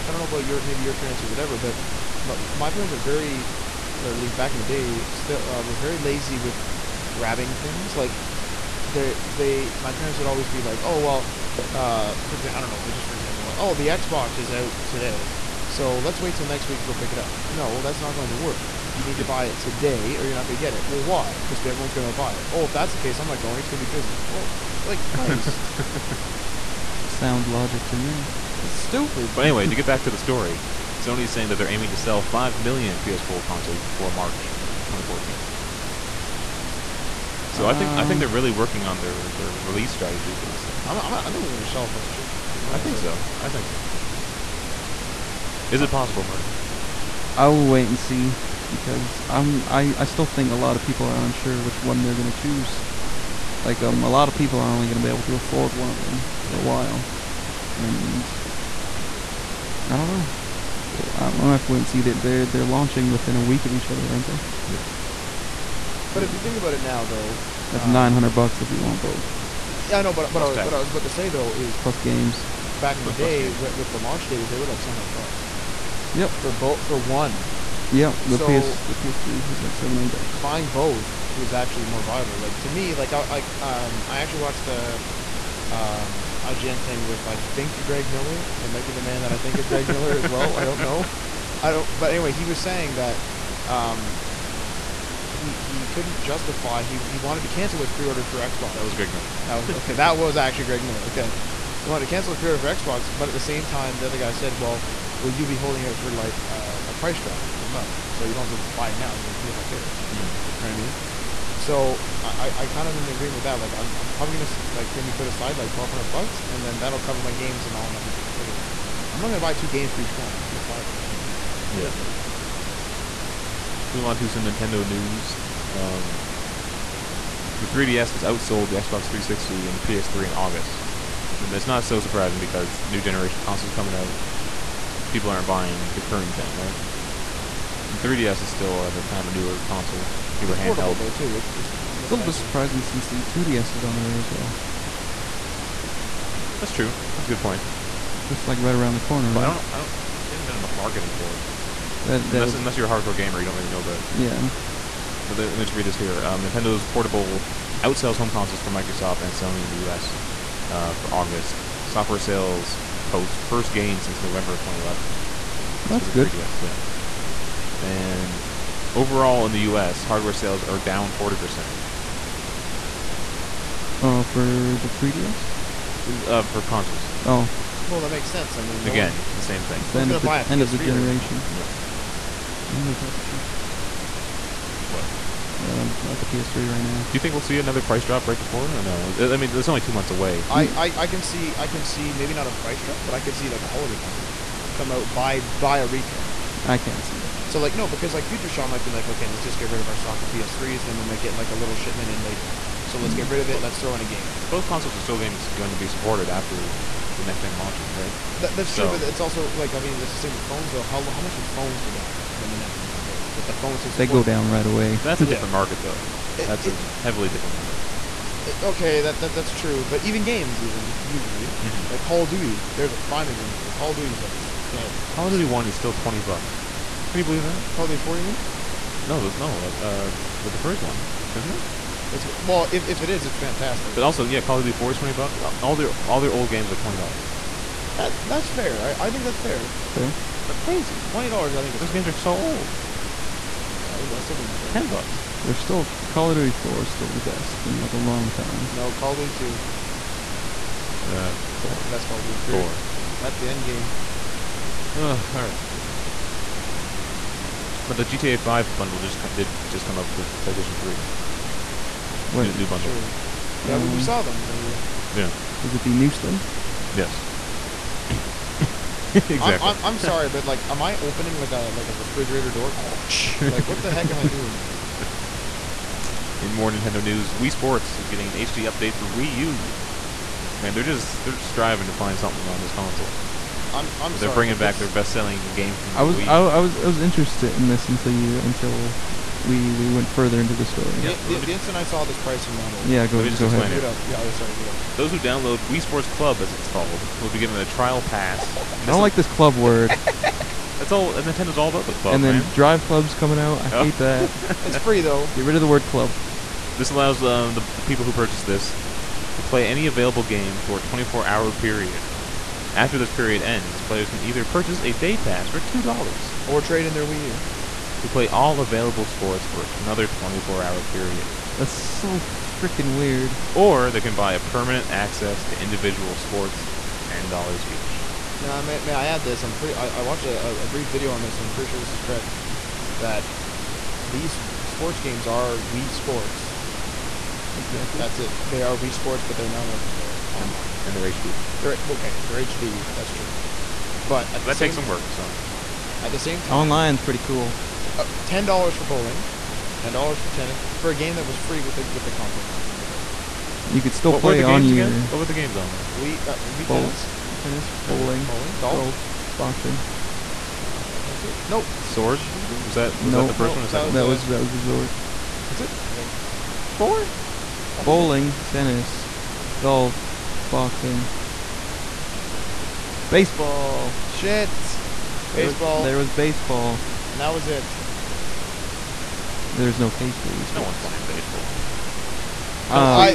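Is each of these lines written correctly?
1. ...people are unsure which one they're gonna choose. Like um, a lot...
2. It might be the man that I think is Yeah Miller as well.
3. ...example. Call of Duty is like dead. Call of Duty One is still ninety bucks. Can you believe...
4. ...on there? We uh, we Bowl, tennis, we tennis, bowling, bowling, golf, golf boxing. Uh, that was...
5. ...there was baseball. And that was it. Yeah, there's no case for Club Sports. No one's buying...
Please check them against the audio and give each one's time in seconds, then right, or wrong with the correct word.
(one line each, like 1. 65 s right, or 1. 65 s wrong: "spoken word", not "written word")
1. 50 s right
2. 88 s wrong: "Greg", not "Yeah"
3. 223 s wrong: "twenty", not "ninety"
4. 355 s right
5. 375 s wrong: "Wii", not "Club".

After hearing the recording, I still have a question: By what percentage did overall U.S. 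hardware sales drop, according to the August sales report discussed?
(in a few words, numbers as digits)
40%.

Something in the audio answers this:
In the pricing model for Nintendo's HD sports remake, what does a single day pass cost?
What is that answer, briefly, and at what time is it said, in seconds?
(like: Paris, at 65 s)
$2, at 315 s.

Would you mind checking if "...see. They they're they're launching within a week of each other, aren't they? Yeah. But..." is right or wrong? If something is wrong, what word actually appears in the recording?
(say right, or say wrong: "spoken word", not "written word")
right.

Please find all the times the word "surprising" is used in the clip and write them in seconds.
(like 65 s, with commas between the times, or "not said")
131 s, 142 s.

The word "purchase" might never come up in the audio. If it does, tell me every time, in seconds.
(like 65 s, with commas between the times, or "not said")
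308 s, 314 s.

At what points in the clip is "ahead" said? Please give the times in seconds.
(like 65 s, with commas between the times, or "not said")
293 s.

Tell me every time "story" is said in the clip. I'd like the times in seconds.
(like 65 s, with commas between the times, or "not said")
30 s, 290 s.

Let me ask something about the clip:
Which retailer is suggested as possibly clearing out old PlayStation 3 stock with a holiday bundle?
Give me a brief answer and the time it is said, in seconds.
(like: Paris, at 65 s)
Future Shop, at 198 s.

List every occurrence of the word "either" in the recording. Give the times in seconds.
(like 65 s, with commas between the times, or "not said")
314 s.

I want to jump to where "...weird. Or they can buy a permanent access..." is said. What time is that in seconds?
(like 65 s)
322 s.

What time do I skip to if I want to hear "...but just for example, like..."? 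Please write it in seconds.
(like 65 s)
12 s.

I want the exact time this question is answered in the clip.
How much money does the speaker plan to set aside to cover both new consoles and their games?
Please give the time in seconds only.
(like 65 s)
115 s.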